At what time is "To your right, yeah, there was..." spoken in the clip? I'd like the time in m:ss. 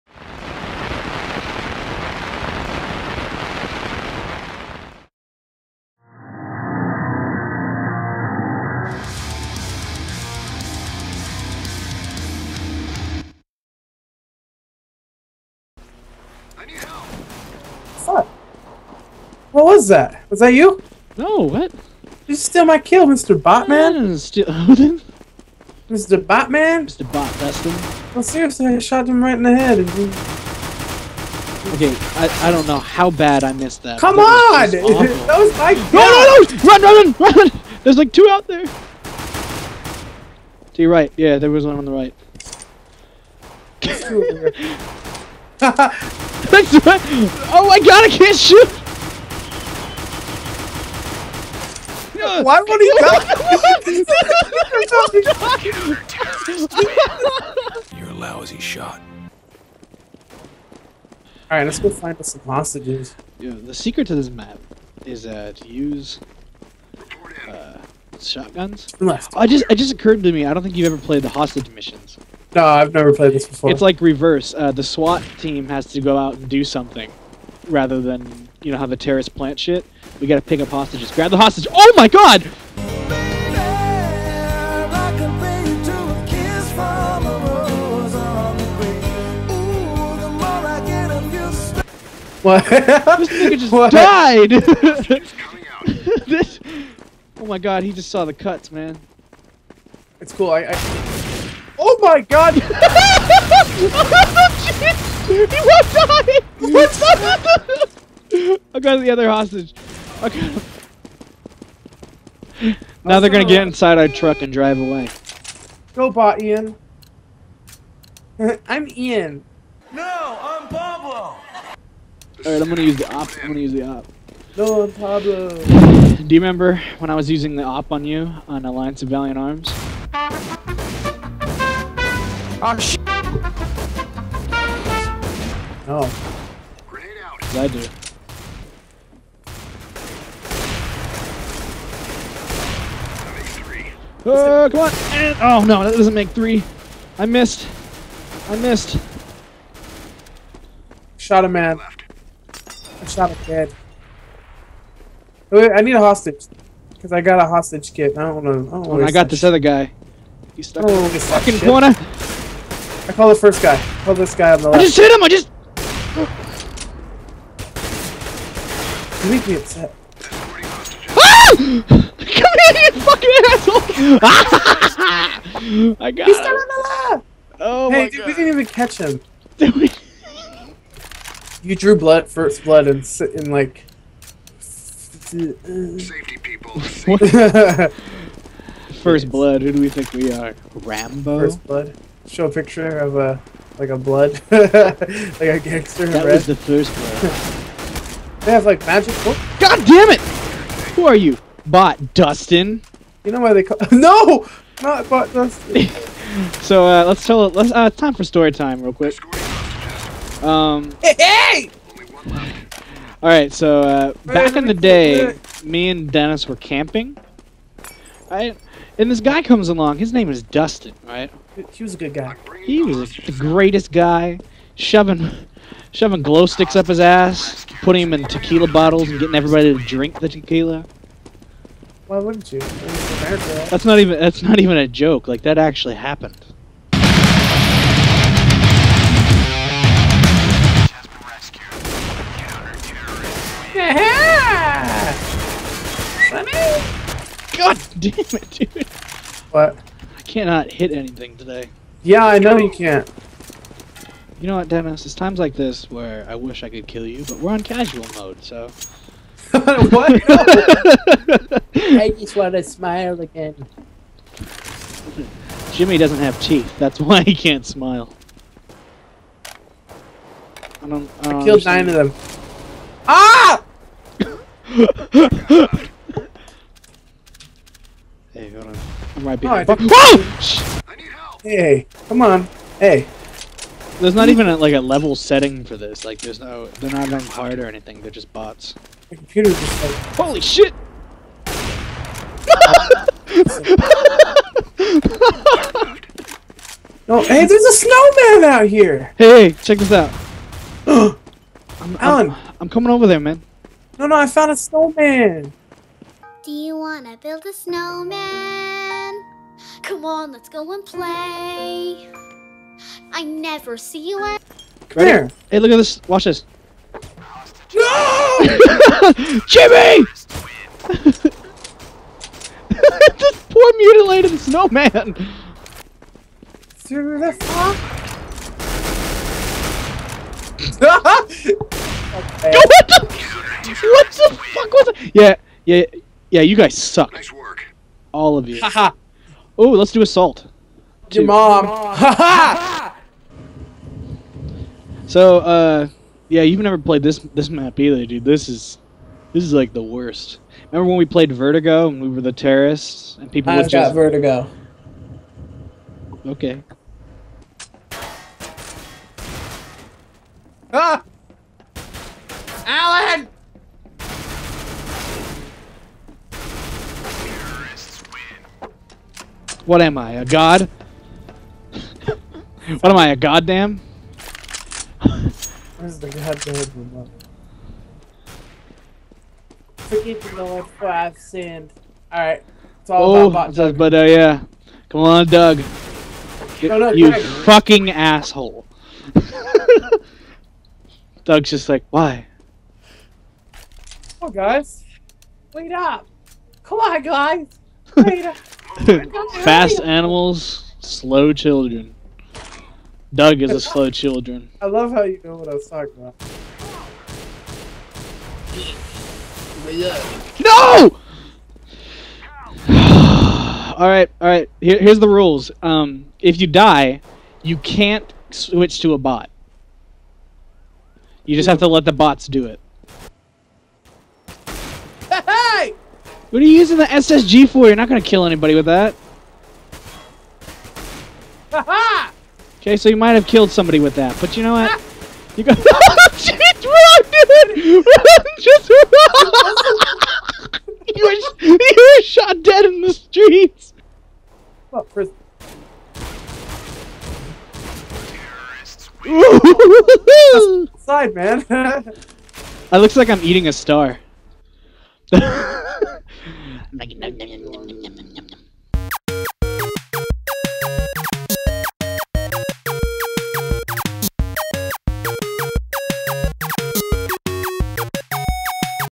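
0:40.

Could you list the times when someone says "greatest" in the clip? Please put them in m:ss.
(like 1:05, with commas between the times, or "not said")
3:43.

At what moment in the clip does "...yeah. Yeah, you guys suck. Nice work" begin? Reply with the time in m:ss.
5:35.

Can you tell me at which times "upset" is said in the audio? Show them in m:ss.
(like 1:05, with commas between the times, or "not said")
2:49.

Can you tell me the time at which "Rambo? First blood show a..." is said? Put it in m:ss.
3:10.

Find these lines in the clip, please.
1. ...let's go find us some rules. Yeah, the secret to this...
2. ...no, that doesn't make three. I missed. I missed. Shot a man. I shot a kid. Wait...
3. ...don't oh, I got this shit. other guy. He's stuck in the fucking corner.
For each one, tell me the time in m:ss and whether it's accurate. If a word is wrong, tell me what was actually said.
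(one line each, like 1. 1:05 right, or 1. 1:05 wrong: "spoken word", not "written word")
1. 1:01 wrong: "hostages", not "rules"
2. 2:25 right
3. 2:38 right.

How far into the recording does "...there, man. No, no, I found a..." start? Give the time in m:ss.
5:03.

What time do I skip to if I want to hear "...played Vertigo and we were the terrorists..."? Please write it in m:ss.
5:51.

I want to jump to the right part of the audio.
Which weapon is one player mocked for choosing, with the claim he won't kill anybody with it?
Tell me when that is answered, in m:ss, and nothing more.
7:06.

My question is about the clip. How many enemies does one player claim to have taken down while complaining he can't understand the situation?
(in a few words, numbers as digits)
9.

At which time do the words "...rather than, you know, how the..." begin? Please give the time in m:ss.
1:17.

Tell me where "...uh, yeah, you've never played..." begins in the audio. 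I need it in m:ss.
5:45.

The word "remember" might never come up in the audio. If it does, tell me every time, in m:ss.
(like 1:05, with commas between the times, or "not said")
2:06, 5:50.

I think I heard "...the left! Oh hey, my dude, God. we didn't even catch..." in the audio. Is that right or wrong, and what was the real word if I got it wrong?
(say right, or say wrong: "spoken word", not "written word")
right.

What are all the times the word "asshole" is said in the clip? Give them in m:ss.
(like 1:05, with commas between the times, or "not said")
2:53, 6:27.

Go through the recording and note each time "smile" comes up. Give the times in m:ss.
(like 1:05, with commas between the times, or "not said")
4:22, 4:27.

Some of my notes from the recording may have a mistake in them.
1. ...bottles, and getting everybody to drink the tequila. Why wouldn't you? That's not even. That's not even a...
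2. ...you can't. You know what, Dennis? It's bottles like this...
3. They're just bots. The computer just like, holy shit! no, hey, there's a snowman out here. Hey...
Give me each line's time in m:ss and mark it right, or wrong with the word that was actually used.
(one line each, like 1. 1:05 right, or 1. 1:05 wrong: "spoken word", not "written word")
1. 3:48 right
2. 4:12 wrong: "times", not "bottles"
3. 4:48 right.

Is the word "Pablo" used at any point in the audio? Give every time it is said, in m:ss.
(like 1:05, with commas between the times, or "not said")
2:00, 2:04.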